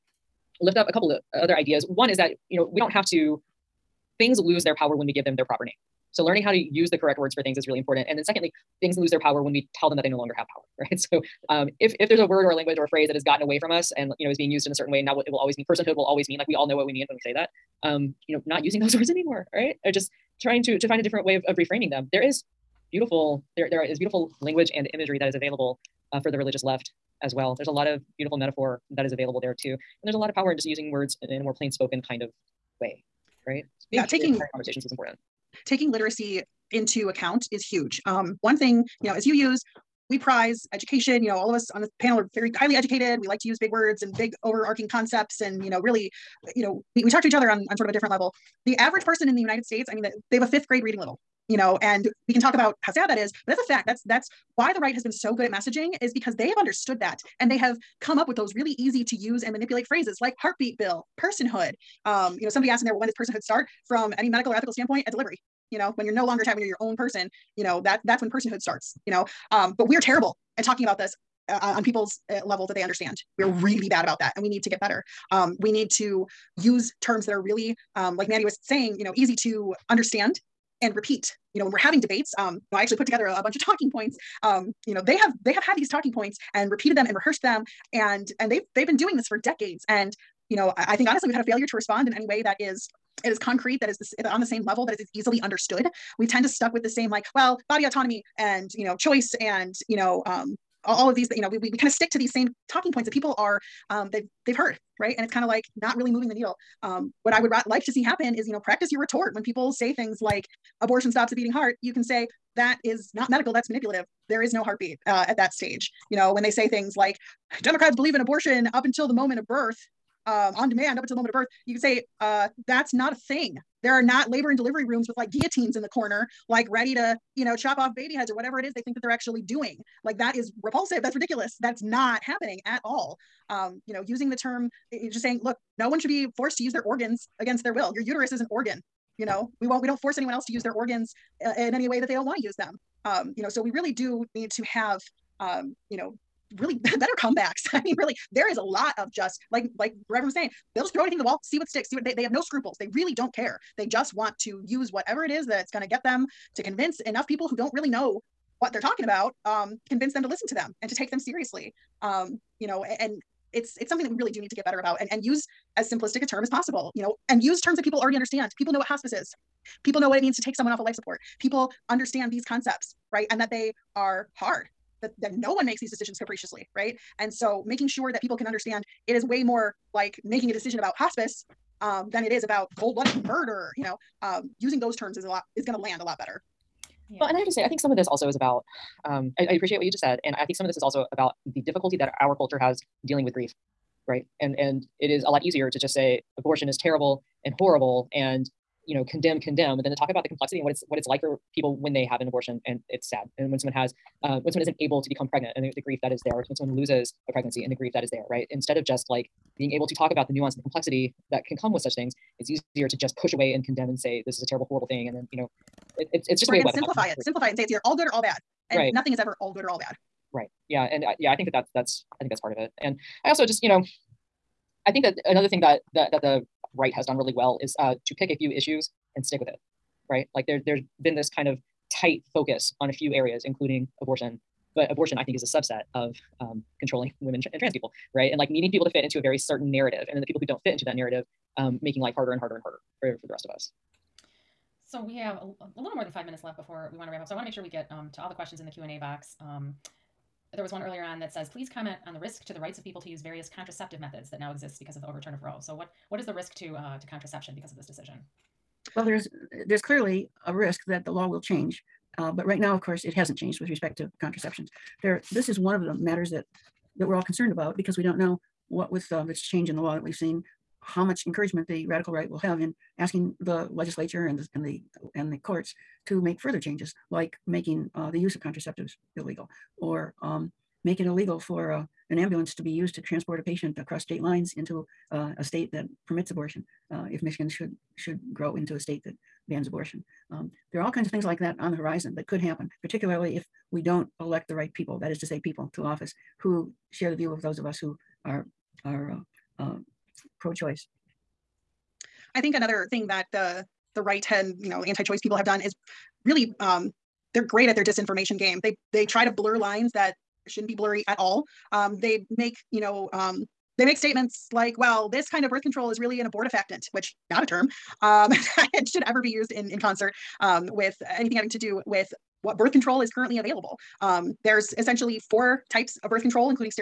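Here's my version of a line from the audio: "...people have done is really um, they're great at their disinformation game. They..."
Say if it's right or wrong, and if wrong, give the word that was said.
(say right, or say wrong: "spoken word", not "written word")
right.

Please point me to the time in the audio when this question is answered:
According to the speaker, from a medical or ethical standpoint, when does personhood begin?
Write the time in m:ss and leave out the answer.
1:05.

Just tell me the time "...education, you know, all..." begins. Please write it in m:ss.
0:40.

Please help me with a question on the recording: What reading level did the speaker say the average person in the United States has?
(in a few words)
fifth grade.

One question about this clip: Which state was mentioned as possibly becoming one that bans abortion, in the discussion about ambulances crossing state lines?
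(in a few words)
Michigan.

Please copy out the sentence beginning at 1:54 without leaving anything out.
There is no heartbeat uh, at that stage.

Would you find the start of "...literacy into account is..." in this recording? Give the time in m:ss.
0:35.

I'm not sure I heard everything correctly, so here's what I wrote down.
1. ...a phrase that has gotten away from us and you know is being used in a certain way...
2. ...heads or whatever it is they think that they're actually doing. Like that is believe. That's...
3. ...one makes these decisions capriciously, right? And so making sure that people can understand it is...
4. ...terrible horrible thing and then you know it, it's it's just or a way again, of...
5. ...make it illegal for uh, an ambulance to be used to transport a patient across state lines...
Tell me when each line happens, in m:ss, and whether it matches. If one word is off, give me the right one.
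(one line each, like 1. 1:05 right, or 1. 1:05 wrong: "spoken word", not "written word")
1. 0:12 right
2. 2:08 wrong: "repulsive", not "believe"
3. 2:55 right
4. 3:34 right
5. 4:40 right.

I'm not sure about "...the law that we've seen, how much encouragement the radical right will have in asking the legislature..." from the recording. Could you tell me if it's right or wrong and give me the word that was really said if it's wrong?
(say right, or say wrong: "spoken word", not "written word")
right.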